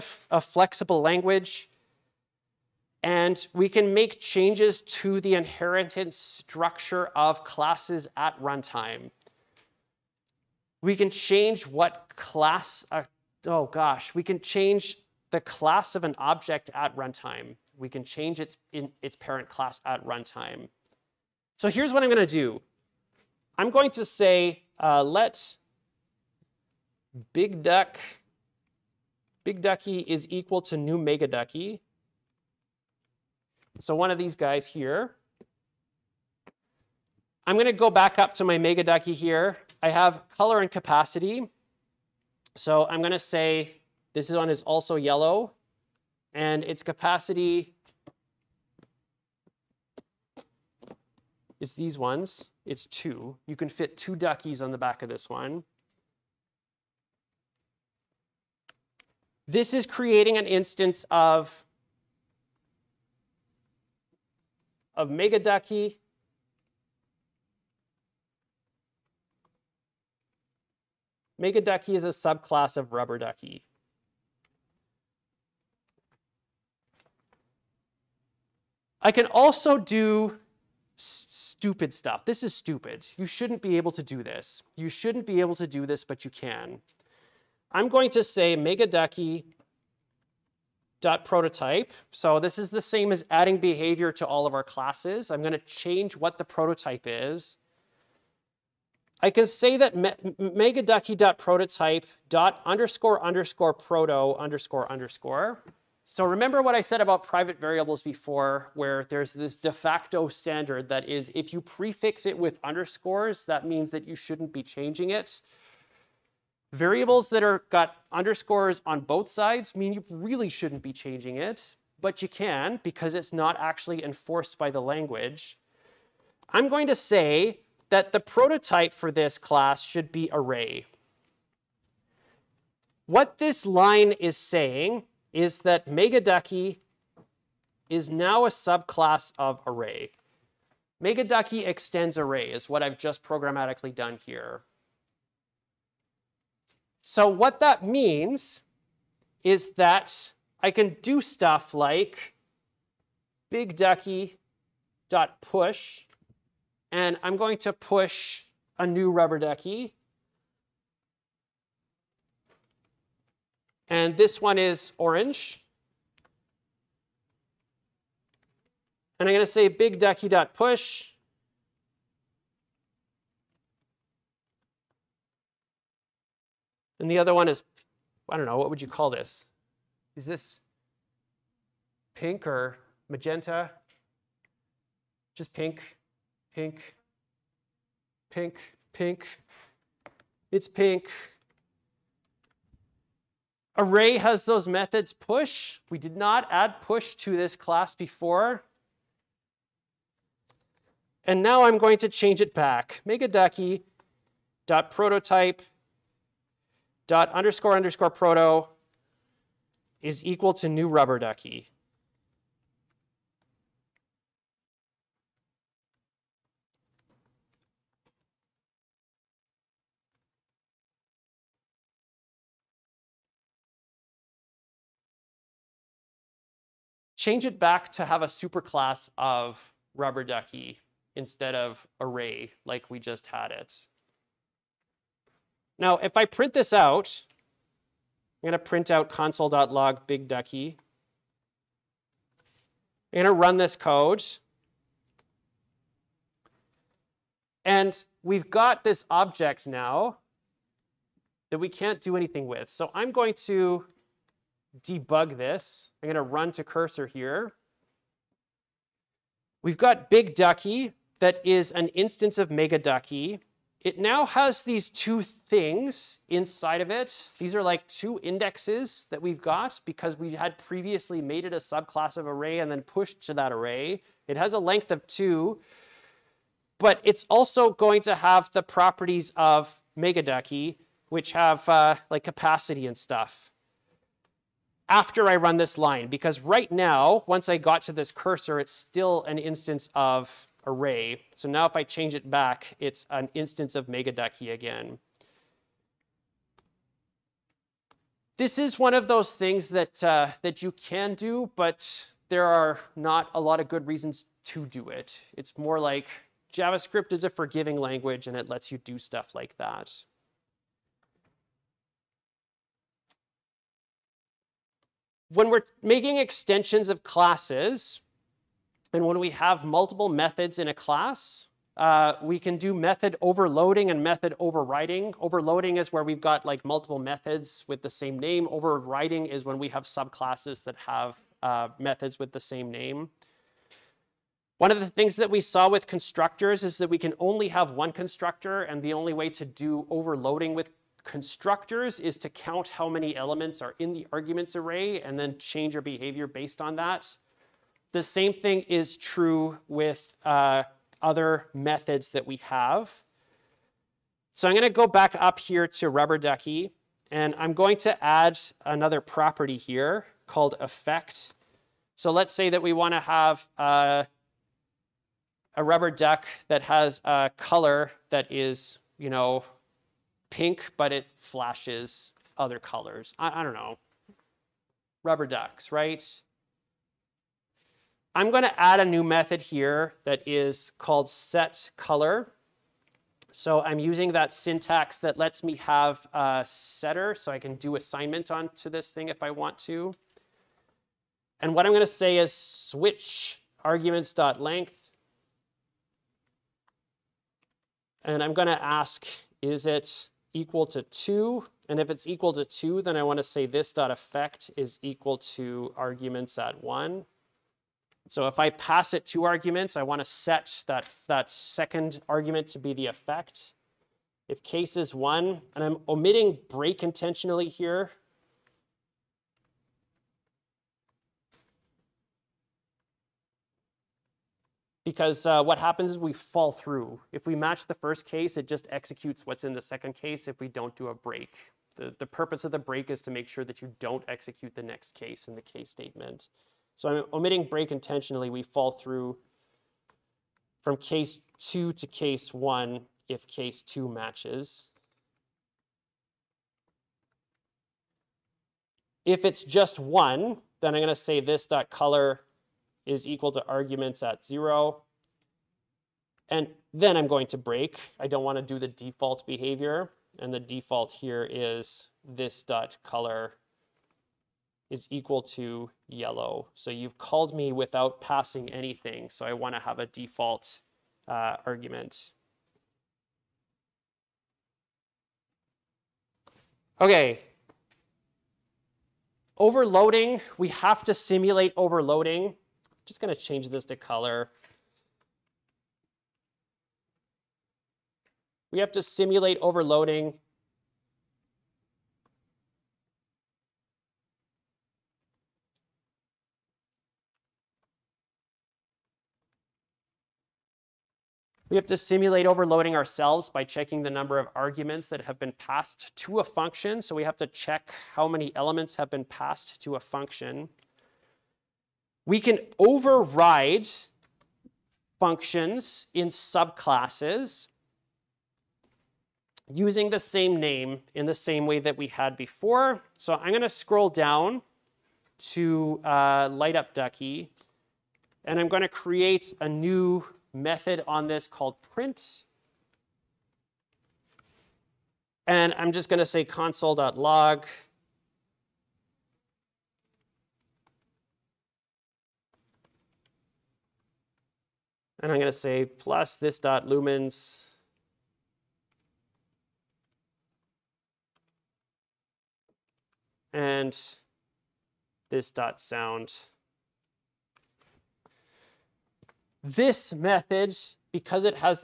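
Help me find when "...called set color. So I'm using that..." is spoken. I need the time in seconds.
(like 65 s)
380 s.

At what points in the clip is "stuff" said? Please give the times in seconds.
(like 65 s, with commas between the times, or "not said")
81 s, 151 s, 282 s, 308 s.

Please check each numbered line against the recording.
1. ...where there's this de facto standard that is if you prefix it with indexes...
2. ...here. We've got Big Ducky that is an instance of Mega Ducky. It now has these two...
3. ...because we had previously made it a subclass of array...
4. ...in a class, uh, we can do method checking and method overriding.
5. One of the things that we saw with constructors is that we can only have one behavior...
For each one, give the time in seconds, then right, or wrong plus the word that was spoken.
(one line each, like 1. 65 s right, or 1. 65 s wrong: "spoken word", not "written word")
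1. 108 s wrong: "underscores", not "indexes"
2. 257 s right
3. 269 s right
4. 320 s wrong: "overloading", not "checking"
5. 334 s wrong: "constructor", not "behavior".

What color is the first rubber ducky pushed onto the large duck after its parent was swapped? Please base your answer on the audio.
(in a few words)
Orange.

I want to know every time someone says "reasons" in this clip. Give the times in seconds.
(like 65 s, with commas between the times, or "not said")
303 s.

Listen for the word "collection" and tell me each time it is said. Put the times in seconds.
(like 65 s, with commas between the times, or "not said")
not said.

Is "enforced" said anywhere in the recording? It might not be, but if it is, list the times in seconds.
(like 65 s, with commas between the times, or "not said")
124 s.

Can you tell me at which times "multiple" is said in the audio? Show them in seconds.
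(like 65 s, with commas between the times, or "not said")
319 s, 326 s.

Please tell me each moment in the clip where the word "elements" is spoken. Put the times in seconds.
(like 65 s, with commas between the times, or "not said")
343 s, 508 s.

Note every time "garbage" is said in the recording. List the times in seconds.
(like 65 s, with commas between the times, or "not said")
not said.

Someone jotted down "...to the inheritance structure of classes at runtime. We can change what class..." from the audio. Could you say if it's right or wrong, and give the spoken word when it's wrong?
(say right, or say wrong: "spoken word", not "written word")
right.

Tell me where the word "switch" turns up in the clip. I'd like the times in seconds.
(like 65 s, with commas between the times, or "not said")
392 s.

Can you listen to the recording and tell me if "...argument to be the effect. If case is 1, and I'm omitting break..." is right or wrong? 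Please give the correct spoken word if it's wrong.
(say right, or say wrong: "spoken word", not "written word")
right.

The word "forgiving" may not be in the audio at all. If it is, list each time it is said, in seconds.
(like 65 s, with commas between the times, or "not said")
307 s.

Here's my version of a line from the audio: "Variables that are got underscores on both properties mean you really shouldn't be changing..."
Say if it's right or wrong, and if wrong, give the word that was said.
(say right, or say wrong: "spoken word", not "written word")
wrong: "sides", not "properties".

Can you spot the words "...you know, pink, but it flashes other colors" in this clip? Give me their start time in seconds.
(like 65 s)
368 s.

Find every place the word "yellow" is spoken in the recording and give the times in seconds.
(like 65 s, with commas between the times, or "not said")
44 s, 465 s.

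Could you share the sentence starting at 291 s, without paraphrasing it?
So now if I change it back, it's an instance of megaducky again.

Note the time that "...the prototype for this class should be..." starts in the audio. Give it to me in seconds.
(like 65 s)
128 s.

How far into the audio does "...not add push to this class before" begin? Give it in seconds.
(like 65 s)
196 s.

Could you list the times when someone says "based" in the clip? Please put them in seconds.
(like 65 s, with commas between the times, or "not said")
346 s.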